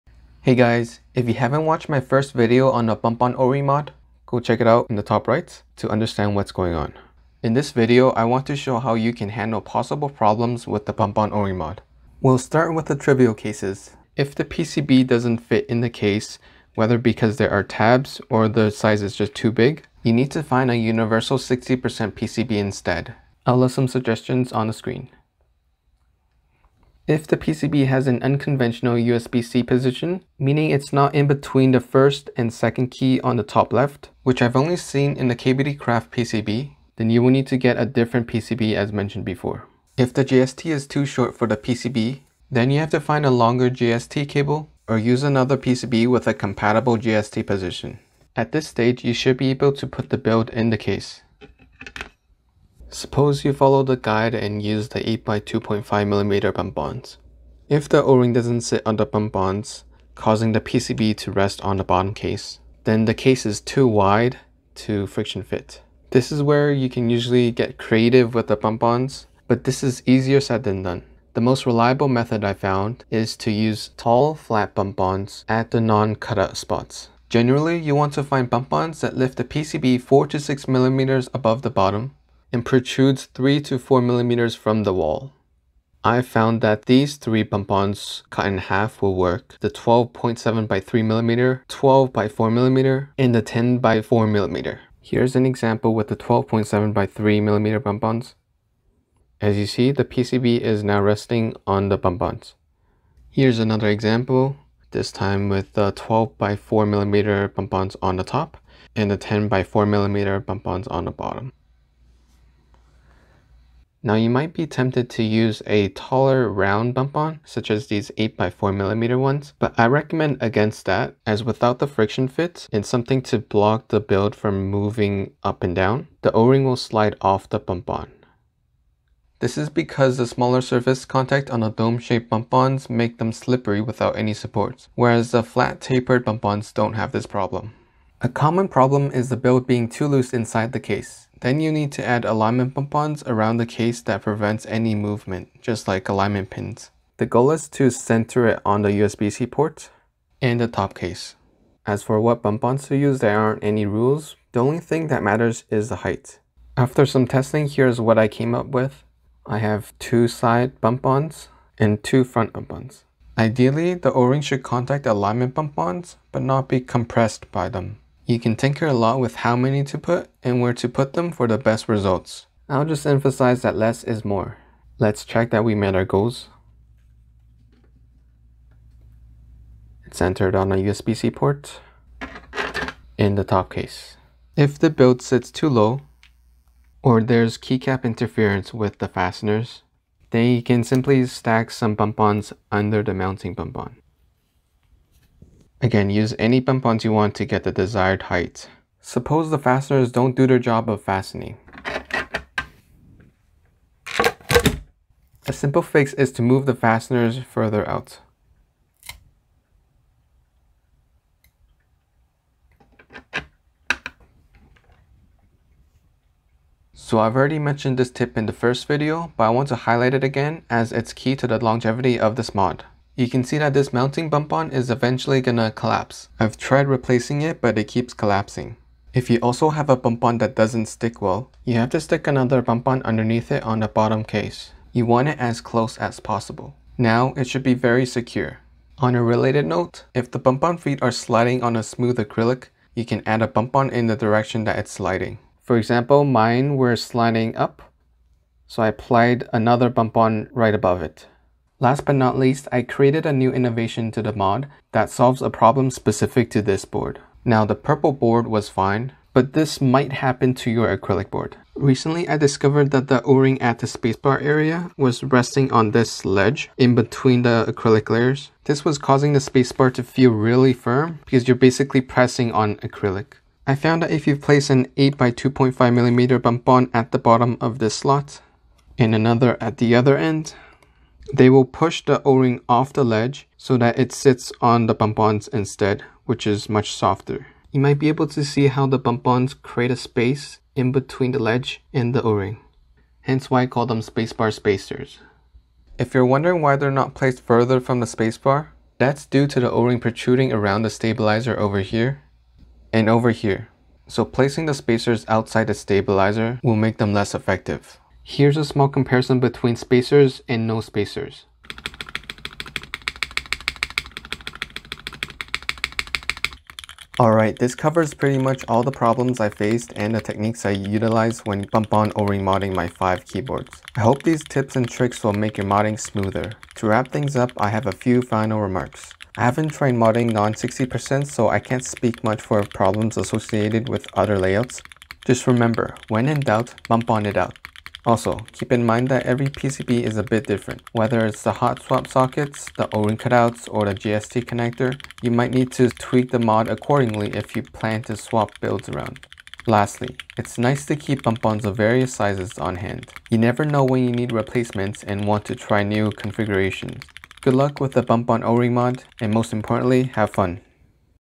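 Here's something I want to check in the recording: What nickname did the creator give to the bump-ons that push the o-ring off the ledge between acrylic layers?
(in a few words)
spacebar spacers.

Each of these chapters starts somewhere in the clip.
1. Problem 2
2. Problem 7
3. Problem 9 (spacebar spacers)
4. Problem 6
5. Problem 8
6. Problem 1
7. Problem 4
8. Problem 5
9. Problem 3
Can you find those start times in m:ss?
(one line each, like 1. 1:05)
1. 0:27
2. 3:19
3. 4:11
4. 3:04
5. 3:37
6. 0:14
7. 0:57
8. 2:18
9. 0:40.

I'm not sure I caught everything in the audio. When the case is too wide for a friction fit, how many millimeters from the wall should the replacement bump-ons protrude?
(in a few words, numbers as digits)
3 to 4 millimeters.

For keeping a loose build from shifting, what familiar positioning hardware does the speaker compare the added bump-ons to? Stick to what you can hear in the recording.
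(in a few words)
alignment pins.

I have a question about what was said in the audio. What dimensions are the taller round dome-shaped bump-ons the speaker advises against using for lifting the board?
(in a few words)
8x4mm.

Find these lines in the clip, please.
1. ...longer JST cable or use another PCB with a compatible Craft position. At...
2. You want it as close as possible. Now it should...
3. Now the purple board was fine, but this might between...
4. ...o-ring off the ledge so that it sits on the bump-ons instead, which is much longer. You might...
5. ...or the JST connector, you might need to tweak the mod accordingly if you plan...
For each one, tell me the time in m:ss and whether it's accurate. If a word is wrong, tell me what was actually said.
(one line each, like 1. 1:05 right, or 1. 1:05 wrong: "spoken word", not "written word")
1. 0:43 wrong: "JST", not "Craft"
2. 3:54 right
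3. 4:17 wrong: "happen", not "between"
4. 4:42 wrong: "softer", not "longer"
5. 5:43 right.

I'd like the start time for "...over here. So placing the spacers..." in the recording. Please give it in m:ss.
5:03.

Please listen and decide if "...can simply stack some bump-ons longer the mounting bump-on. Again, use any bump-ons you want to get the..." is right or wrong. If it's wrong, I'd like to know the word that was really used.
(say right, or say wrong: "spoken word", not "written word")
wrong: "under", not "longer".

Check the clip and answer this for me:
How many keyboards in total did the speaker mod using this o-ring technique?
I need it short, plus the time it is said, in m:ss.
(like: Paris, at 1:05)
5, at 5:22.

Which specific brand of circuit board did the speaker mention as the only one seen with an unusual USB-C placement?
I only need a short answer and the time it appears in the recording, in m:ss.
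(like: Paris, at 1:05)
KBD Craft, at 0:35.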